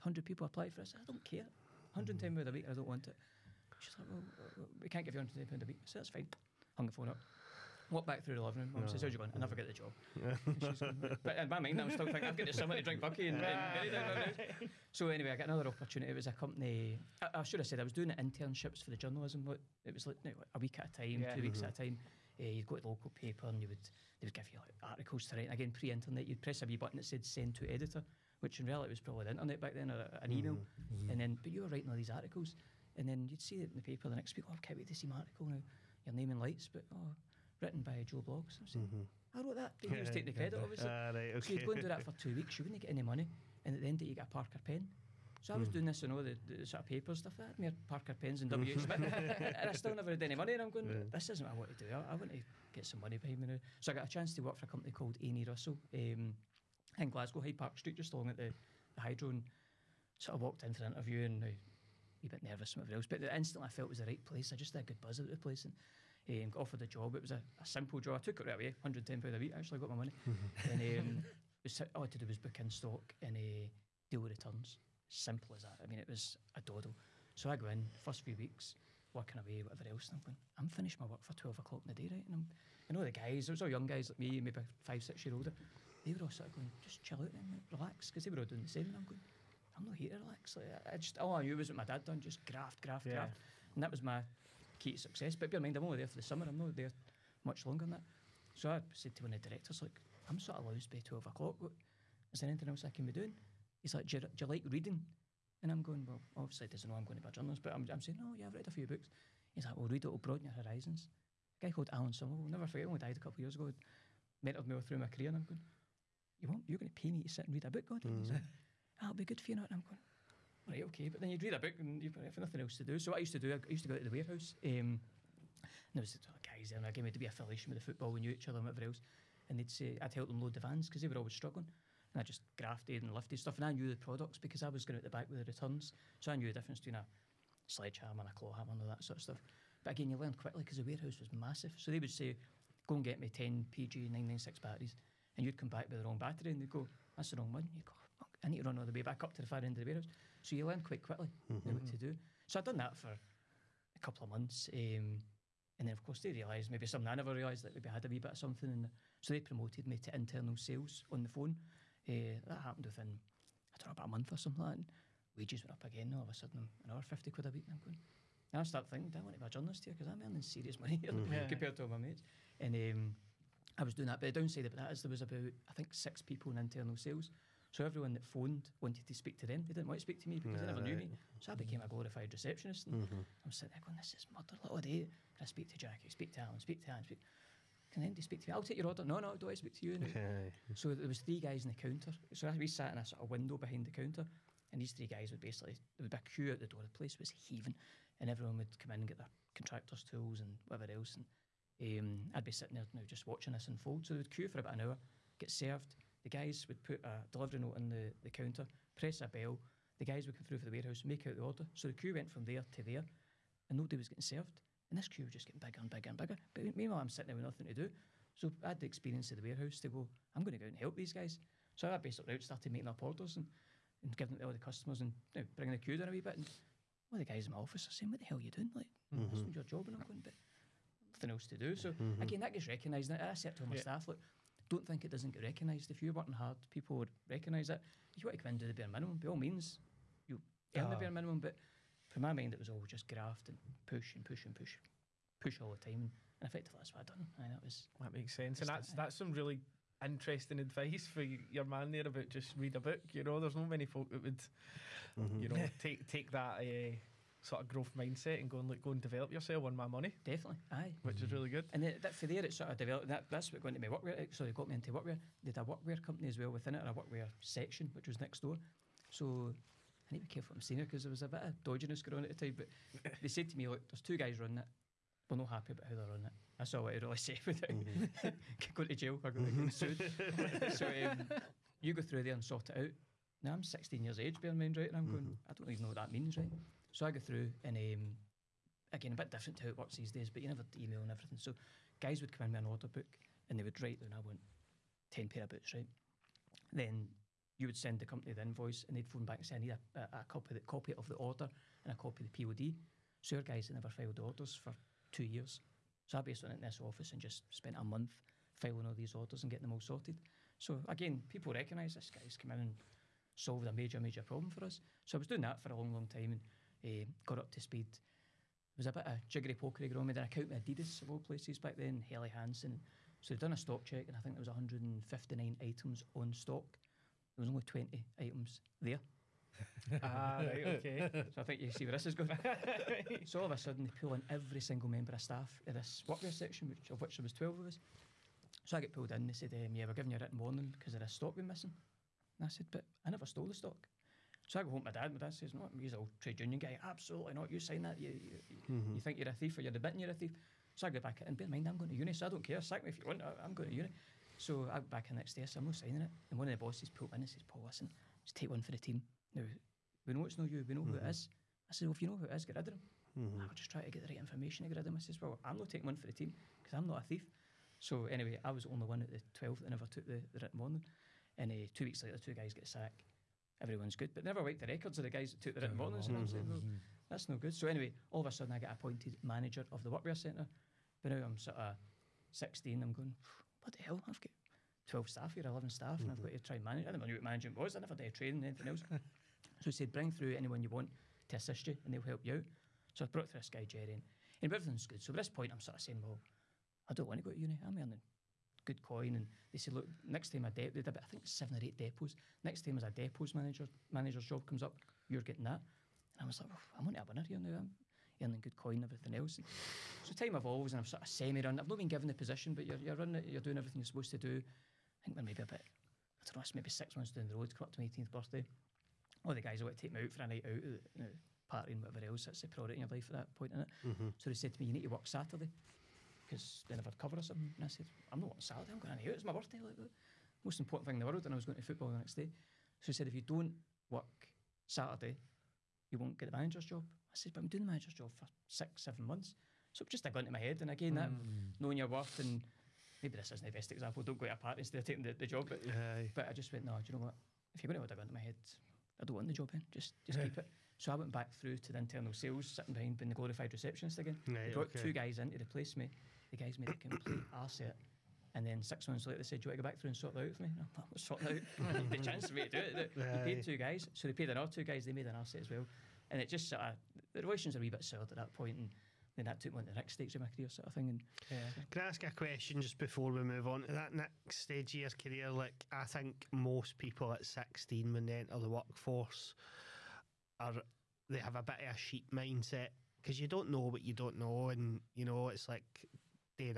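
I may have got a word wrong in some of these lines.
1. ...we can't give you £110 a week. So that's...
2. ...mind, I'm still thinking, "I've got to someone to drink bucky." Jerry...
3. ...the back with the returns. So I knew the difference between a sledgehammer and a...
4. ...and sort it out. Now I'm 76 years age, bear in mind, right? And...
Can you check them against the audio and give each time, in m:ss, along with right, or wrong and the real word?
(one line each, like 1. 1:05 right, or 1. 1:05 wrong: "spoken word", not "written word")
1. 0:04 right
2. 0:11 wrong: "And", not "Jerry"
3. 2:15 right
4. 4:42 wrong: "16", not "76".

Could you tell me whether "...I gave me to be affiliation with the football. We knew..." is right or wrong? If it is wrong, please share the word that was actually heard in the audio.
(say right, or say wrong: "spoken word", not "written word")
right.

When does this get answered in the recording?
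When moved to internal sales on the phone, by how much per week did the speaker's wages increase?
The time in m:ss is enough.
2:47.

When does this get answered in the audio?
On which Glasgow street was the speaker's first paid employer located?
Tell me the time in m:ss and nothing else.
0:57.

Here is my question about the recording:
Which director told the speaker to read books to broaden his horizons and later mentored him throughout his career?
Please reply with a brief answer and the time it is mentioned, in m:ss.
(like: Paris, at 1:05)
Alan Somerville, at 1:51.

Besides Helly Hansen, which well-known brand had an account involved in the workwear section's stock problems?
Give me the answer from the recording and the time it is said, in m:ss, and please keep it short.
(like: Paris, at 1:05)
Adidas, at 5:20.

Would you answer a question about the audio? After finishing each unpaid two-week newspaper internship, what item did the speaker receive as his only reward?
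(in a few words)
Parker pen.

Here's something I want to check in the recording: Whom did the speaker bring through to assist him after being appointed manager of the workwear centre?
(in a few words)
Jerry.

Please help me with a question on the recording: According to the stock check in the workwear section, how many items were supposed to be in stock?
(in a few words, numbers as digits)
159.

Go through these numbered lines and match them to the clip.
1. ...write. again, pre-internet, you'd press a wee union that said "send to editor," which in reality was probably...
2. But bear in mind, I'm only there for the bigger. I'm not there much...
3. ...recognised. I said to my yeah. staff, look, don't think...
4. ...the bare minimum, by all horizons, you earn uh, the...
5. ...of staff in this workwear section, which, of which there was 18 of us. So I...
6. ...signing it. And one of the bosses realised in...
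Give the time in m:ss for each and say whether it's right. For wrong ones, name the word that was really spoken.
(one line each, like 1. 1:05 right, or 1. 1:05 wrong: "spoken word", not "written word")
1. 0:25 wrong: "button", not "union"
2. 1:35 wrong: "summer", not "bigger"
3. 3:52 right
4. 3:58 wrong: "means", not "horizons"
5. 5:35 wrong: "12", not "18"
6. 5:55 wrong: "pulled", not "realised".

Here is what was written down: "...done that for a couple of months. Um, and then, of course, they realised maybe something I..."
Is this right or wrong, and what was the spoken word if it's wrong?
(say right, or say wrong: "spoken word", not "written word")
right.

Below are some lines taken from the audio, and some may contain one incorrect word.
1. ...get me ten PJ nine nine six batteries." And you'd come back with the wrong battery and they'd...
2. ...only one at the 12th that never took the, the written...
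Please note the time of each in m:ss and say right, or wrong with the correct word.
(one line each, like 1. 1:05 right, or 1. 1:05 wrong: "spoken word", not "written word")
1. 2:23 right
2. 6:08 right.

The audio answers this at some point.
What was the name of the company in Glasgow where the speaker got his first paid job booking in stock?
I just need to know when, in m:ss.
0:55.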